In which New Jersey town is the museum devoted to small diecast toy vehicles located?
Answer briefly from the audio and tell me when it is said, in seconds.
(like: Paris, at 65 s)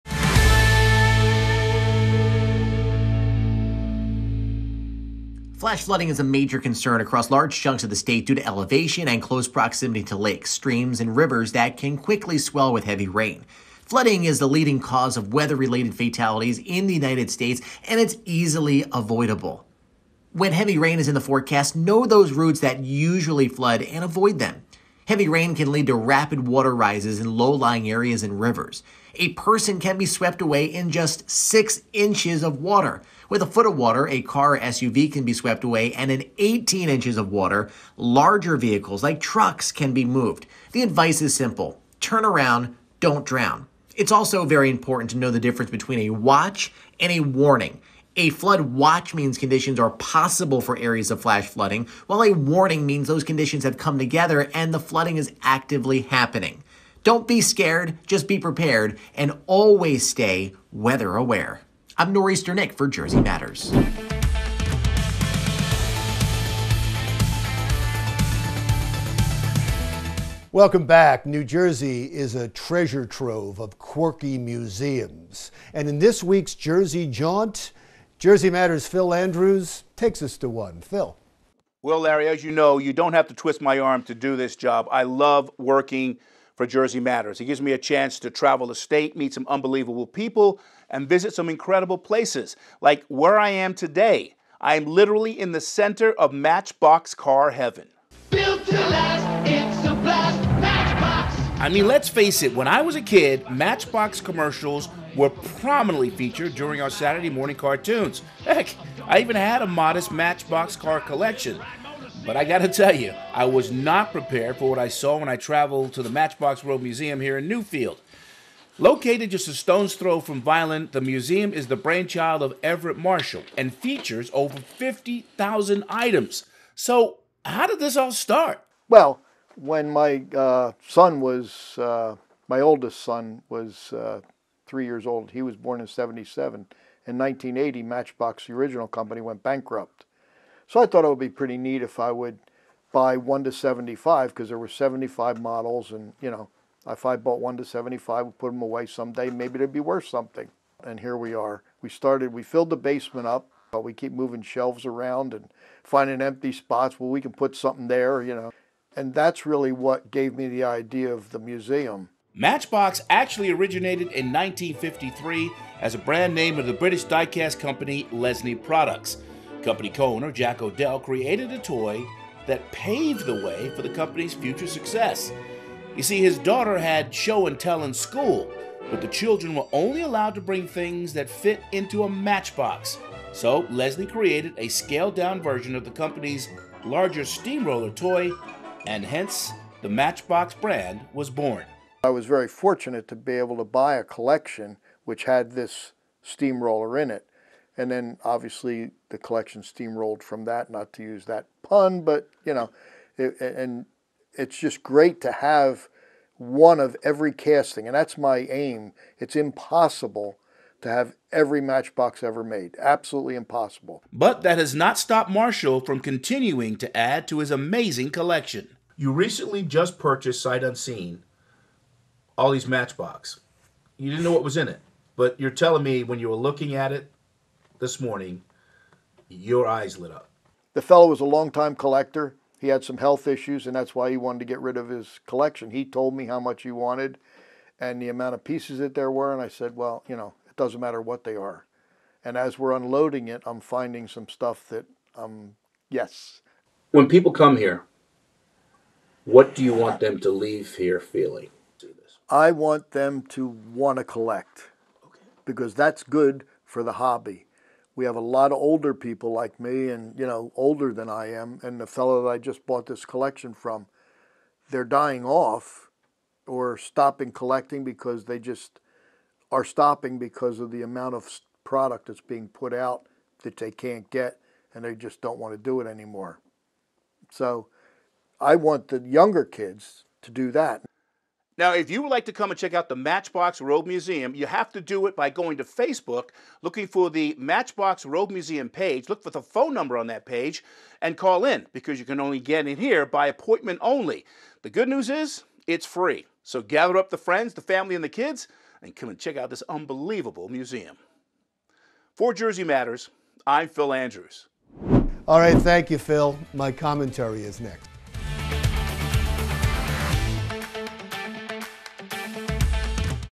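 Newfield, at 117 s.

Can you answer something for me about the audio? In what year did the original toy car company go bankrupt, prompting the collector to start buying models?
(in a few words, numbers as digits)
1980.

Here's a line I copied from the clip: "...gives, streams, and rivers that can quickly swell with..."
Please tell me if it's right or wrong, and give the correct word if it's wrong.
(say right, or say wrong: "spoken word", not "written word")
wrong: "lakes", not "gives".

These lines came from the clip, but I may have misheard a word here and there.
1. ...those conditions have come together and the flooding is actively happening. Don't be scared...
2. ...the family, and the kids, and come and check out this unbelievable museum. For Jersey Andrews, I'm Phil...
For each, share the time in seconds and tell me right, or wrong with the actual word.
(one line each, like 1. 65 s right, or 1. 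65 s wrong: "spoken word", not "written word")
1. 53 s right
2. 297 s wrong: "Matters", not "Andrews".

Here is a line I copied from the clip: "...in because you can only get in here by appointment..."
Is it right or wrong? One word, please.
right.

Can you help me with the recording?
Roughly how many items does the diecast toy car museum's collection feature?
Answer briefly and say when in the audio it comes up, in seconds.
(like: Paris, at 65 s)
over 50,000, at 124 s.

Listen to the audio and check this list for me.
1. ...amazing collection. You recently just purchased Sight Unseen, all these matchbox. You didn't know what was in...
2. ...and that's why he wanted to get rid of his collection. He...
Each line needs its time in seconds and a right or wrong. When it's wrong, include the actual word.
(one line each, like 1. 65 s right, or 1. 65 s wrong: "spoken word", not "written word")
1. 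217 s right
2. 233 s right.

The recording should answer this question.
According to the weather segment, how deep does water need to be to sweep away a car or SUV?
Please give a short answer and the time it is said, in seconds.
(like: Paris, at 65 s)
a foot, at 33 s.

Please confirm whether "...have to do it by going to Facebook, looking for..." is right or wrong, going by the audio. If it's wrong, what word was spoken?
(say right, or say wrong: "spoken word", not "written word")
right.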